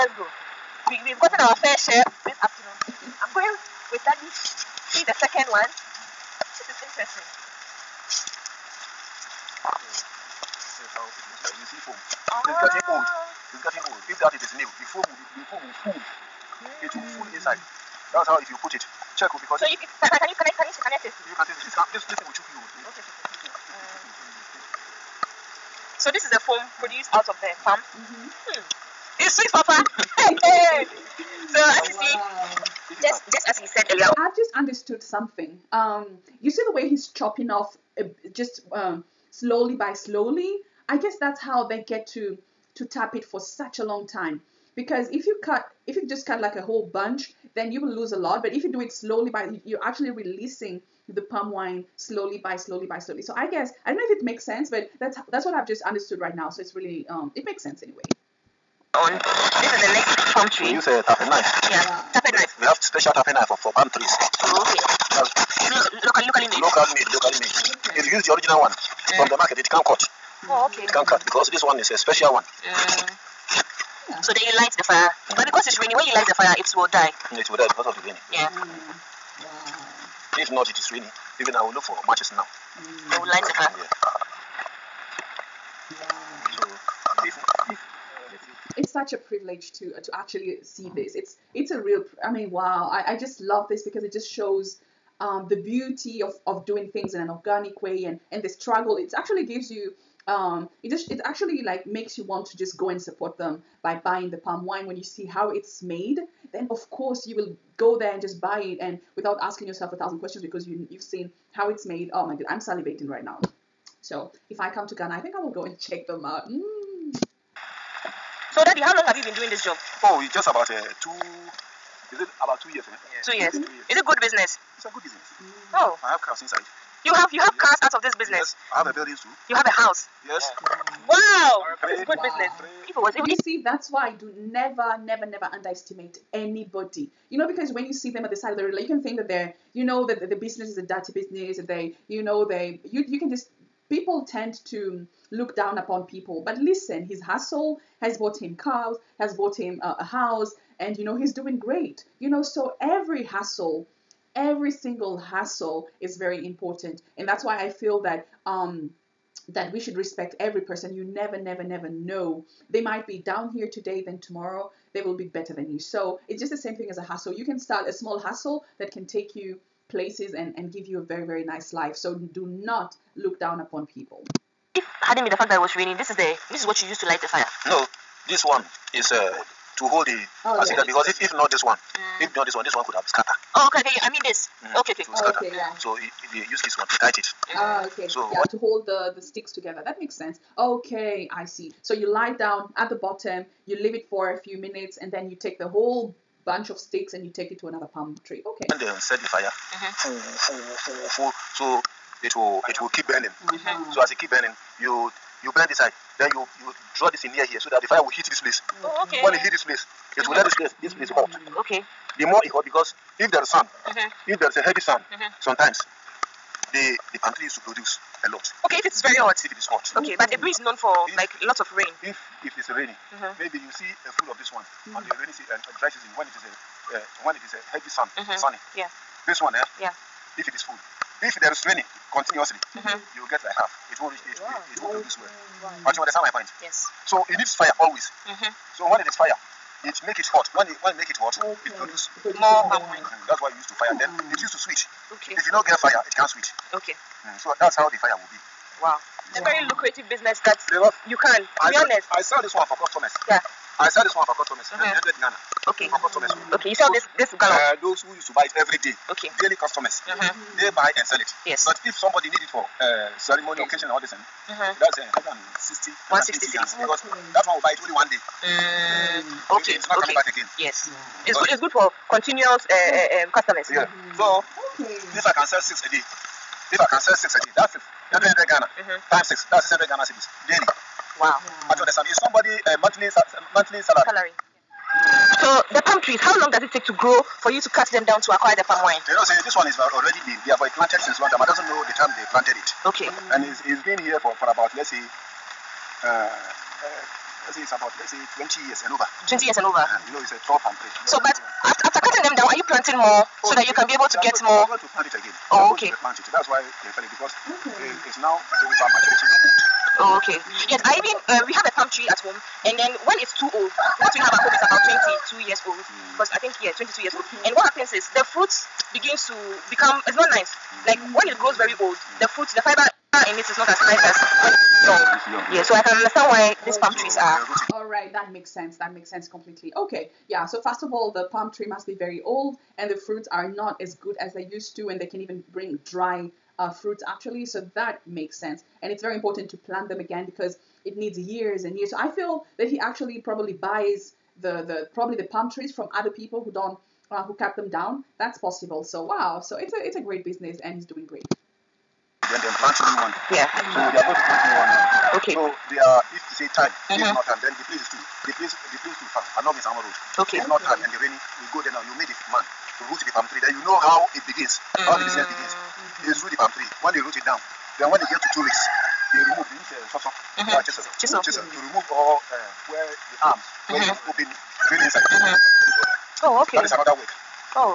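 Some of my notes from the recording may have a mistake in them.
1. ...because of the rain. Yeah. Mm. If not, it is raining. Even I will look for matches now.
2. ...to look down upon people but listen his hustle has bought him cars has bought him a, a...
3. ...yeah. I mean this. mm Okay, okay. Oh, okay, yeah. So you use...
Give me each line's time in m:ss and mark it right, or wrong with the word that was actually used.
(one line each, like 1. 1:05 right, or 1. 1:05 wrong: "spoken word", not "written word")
1. 1:17 right
2. 2:24 right
3. 3:03 right.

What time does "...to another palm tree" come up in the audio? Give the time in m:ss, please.
3:17.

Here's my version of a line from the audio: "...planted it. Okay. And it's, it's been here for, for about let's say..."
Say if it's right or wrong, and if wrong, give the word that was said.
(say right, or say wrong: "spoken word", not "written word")
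right.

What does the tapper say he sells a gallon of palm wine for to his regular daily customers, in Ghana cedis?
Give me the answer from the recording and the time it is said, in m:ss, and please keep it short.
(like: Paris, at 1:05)
100, at 4:15.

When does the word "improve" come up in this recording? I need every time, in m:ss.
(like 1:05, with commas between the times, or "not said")
not said.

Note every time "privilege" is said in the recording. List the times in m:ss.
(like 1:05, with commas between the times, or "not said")
1:29.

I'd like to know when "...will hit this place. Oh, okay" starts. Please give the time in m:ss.
3:28.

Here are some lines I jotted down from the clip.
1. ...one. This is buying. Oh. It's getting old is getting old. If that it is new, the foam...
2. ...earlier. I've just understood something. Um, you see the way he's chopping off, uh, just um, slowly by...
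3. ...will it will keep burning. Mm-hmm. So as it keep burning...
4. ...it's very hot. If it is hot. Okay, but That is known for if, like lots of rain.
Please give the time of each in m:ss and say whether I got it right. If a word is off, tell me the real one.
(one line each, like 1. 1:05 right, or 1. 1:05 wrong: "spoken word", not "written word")
1. 0:05 wrong: "interesting", not "buying"
2. 0:33 right
3. 3:22 right
4. 3:38 wrong: "Aburi", not "That".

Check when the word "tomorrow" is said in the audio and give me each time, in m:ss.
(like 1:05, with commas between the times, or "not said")
2:44.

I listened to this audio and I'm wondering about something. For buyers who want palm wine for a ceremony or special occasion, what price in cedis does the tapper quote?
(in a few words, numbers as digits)
160 cedis.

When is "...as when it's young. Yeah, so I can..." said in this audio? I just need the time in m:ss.
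5:23.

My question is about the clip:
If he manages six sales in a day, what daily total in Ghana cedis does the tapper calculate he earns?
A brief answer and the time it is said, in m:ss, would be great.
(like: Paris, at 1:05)
600, at 4:39.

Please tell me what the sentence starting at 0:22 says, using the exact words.
Okay, So this is the foam produced out of the farm.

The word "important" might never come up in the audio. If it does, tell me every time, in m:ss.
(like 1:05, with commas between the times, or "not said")
2:36, 5:39.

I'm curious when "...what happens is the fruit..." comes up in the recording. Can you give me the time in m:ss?
5:17.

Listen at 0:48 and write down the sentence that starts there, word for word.
But if you do it slowly by, you're actually releasing the palm wine slowly by slowly by slowly.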